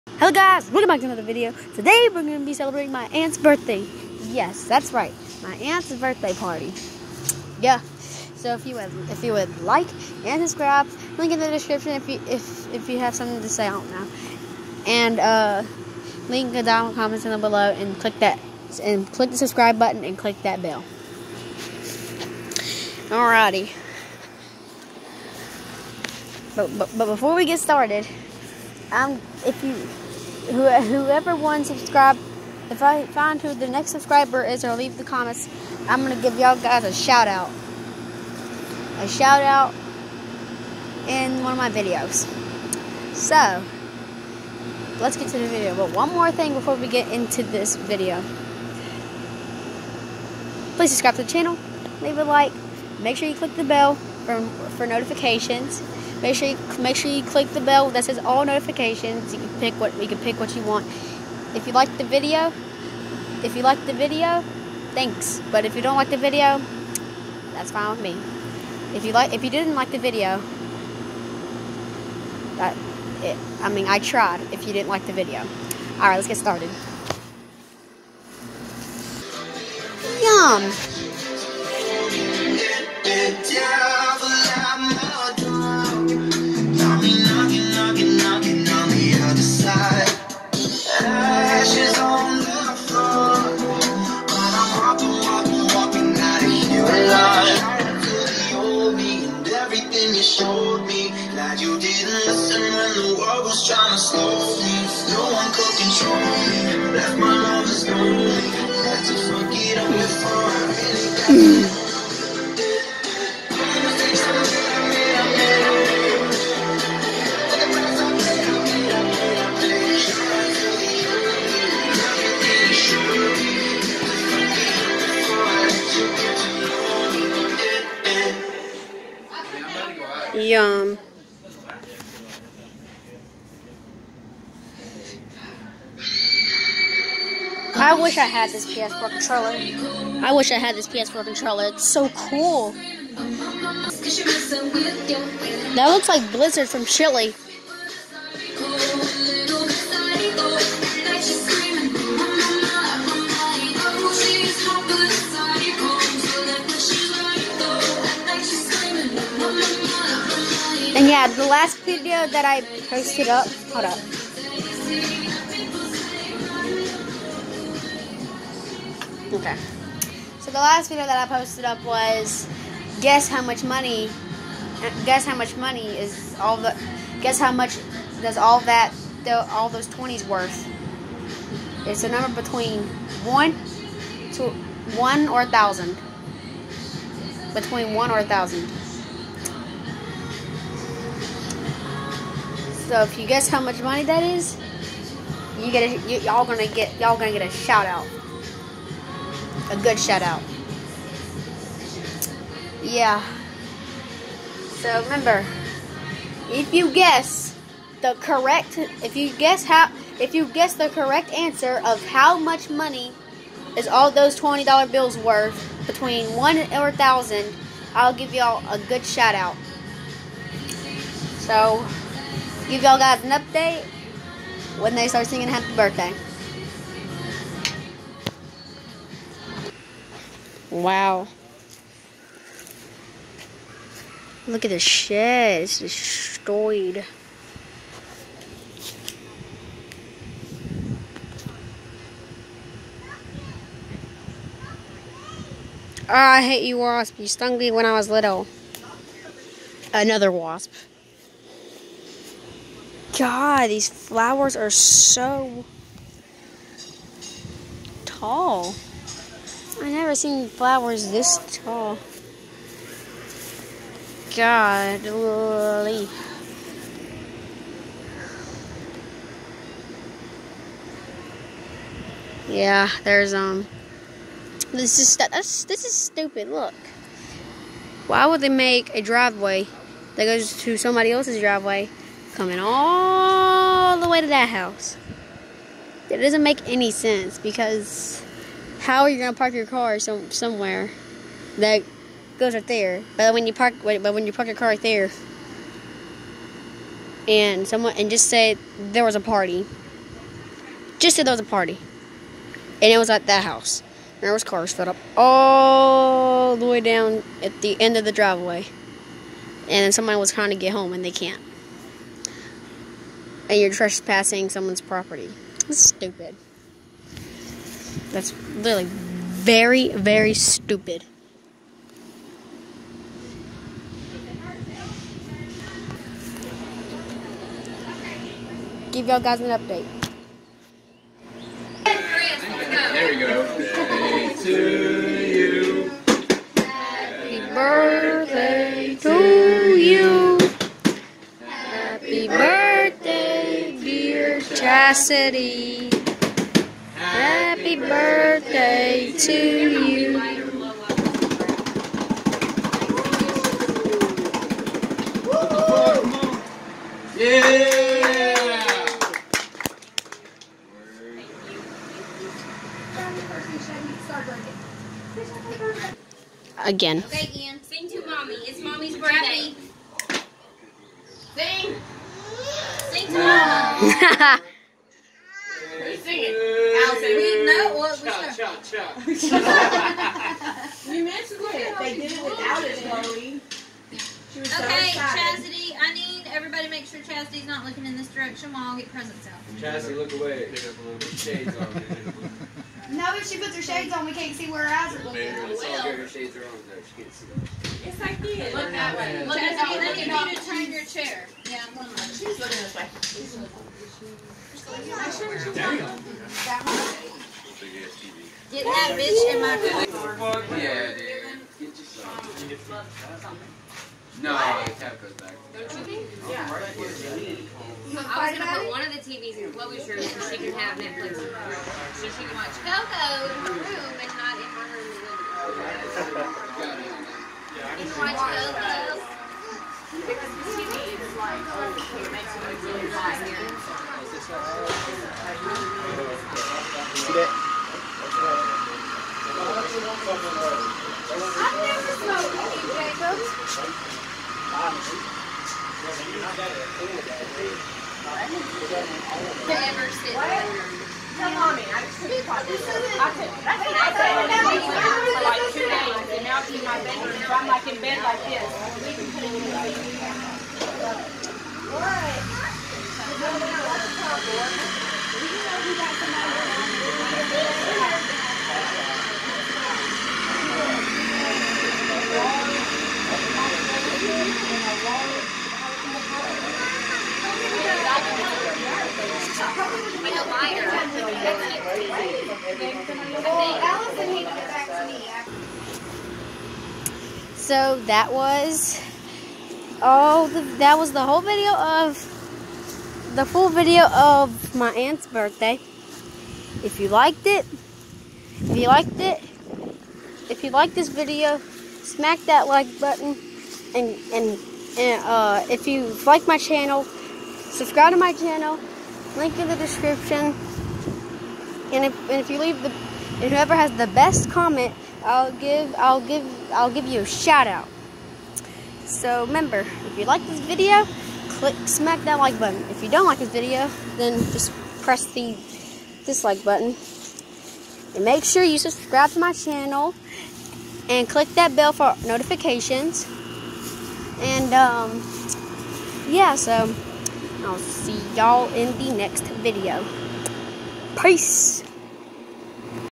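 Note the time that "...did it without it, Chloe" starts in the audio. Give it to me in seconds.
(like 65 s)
381 s.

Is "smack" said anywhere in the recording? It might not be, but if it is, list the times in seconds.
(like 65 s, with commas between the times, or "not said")
501 s, 521 s.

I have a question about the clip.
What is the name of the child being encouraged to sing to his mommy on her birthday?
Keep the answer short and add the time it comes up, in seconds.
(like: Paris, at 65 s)
Ian, at 367 s.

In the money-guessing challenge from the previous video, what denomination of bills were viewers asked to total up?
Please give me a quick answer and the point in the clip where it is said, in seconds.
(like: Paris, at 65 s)
20s, at 179 s.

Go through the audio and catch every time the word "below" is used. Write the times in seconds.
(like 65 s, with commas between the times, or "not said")
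17 s.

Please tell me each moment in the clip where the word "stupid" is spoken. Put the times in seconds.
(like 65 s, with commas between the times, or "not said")
275 s, 315 s, 320 s.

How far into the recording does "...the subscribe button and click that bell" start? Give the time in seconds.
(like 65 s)
19 s.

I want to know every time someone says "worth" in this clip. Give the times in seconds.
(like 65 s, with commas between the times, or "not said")
180 s, 215 s.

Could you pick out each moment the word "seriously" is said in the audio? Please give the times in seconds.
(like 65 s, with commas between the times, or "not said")
not said.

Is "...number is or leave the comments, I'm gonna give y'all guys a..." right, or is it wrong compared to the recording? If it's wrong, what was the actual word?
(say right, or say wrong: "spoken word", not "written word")
wrong: "subscriber", not "number".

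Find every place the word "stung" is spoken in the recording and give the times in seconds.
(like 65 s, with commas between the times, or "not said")
247 s.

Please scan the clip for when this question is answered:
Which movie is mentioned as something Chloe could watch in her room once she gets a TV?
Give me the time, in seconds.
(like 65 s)
422 s.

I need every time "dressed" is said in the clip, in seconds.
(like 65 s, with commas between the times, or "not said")
not said.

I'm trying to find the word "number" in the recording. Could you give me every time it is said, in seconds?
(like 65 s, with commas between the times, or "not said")
182 s.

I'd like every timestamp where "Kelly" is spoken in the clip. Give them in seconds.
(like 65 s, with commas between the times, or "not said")
not said.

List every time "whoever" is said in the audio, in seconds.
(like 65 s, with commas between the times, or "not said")
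30 s, 513 s.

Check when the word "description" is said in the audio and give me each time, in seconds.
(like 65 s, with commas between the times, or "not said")
11 s, 509 s.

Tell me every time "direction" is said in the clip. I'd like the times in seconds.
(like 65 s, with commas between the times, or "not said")
388 s.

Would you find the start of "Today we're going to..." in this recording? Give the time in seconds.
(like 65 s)
1 s.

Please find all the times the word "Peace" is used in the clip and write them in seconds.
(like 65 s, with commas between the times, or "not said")
540 s.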